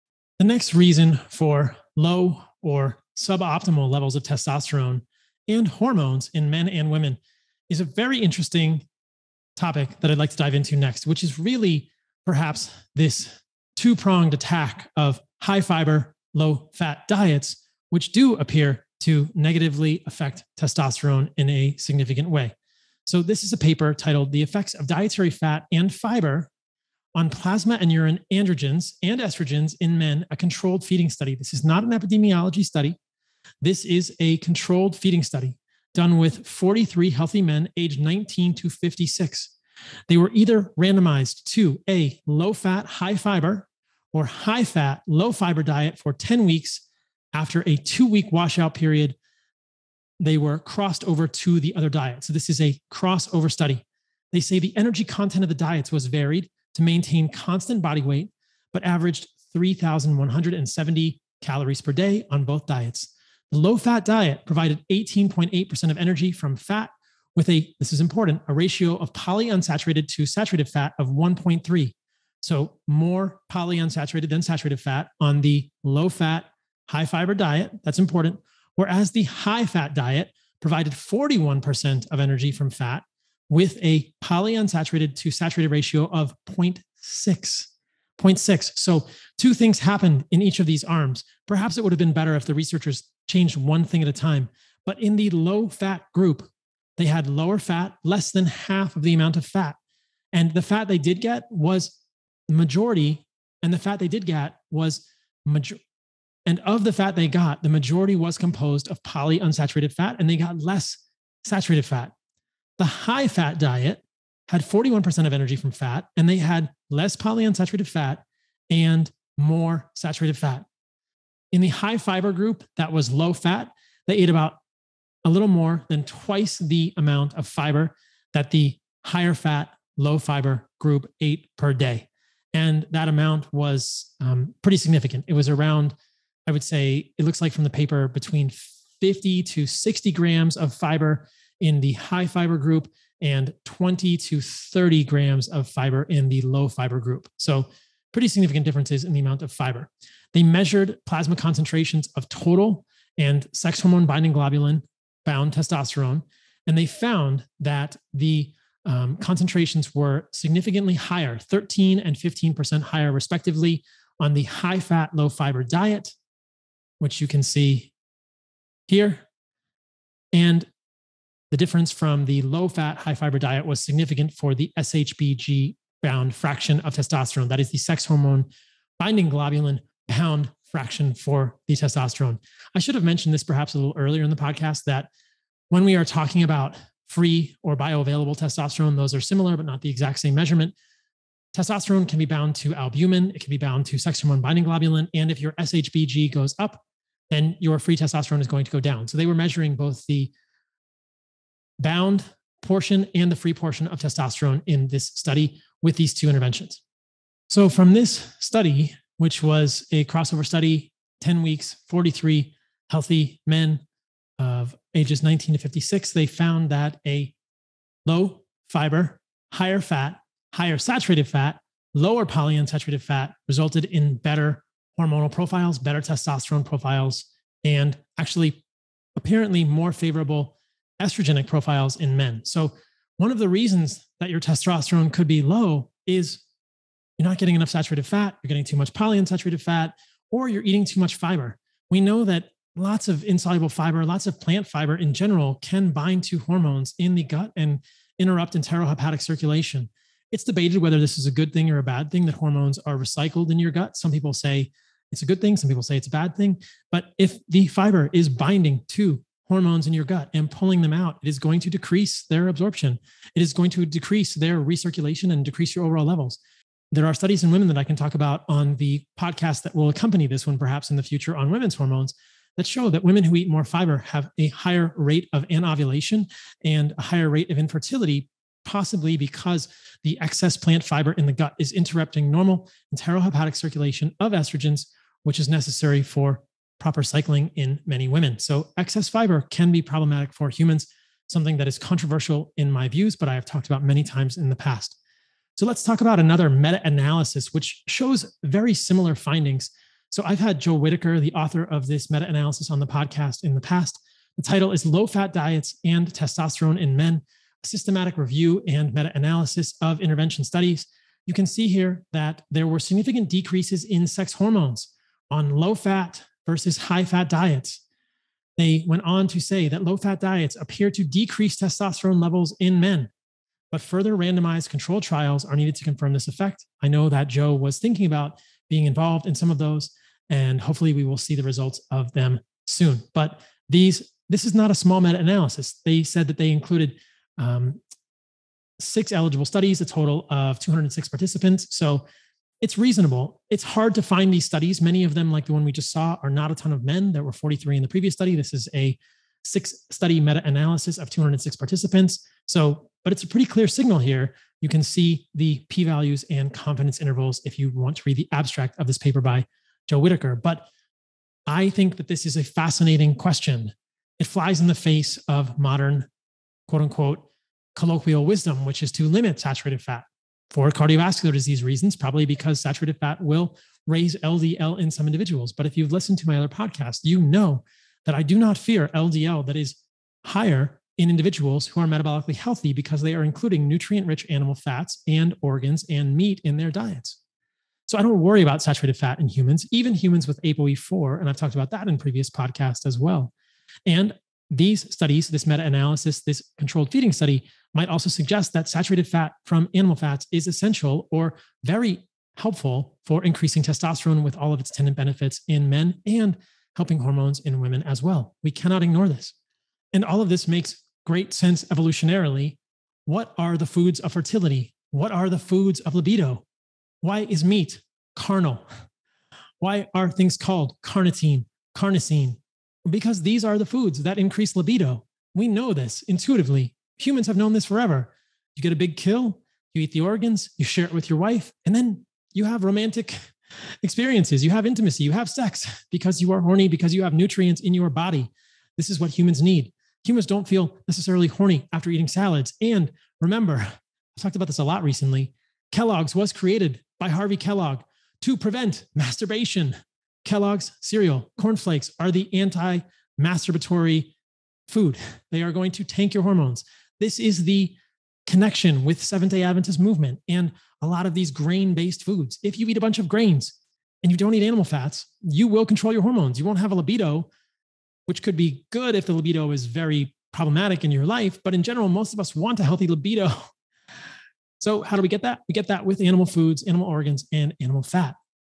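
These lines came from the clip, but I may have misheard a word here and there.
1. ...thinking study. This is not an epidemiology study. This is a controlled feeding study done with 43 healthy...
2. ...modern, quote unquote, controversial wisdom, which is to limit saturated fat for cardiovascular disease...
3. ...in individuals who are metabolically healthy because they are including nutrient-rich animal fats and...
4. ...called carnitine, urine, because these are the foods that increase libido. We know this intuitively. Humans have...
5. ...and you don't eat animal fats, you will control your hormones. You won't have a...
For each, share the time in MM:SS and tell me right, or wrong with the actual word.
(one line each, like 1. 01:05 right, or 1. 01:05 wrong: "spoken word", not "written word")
1. 00:30 wrong: "feeding", not "thinking"
2. 06:05 wrong: "colloquial", not "controversial"
3. 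06:20 right
4. 07:00 wrong: "carnosine", not "urine"
5. 07:44 right.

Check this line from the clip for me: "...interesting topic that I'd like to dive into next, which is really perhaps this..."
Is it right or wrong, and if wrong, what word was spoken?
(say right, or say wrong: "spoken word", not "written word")
right.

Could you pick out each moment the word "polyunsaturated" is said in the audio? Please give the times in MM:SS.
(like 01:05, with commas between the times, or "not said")
01:09, 01:13, 01:24, 01:49, 01:57, 03:42, 03:58.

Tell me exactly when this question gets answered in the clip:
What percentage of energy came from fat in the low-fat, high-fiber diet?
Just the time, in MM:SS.
01:04.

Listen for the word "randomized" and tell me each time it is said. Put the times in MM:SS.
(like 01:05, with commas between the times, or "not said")
00:40, 05:24.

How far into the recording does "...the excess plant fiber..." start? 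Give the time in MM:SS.
04:40.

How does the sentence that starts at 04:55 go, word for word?
So, let's talk about another meta analysis, which shows very similar findings.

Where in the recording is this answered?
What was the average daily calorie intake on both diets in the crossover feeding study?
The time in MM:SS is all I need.
00:59.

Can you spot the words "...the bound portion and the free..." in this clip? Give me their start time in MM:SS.
03:20.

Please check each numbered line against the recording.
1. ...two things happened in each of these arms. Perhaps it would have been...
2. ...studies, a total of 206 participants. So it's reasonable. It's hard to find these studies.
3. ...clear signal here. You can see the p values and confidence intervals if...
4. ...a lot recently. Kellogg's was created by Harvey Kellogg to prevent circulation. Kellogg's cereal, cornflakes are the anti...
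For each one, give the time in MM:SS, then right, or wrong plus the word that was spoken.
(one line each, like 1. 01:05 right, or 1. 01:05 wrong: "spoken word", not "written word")
1. 01:29 right
2. 05:39 right
3. 05:53 right
4. 07:24 wrong: "masturbation", not "circulation".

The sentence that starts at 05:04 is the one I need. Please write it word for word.
The title is Low Fat Diets and Testosterone in Men A Systematic Review and Meta Analysis of Intervention Studies.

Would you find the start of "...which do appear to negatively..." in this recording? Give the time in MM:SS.
00:17.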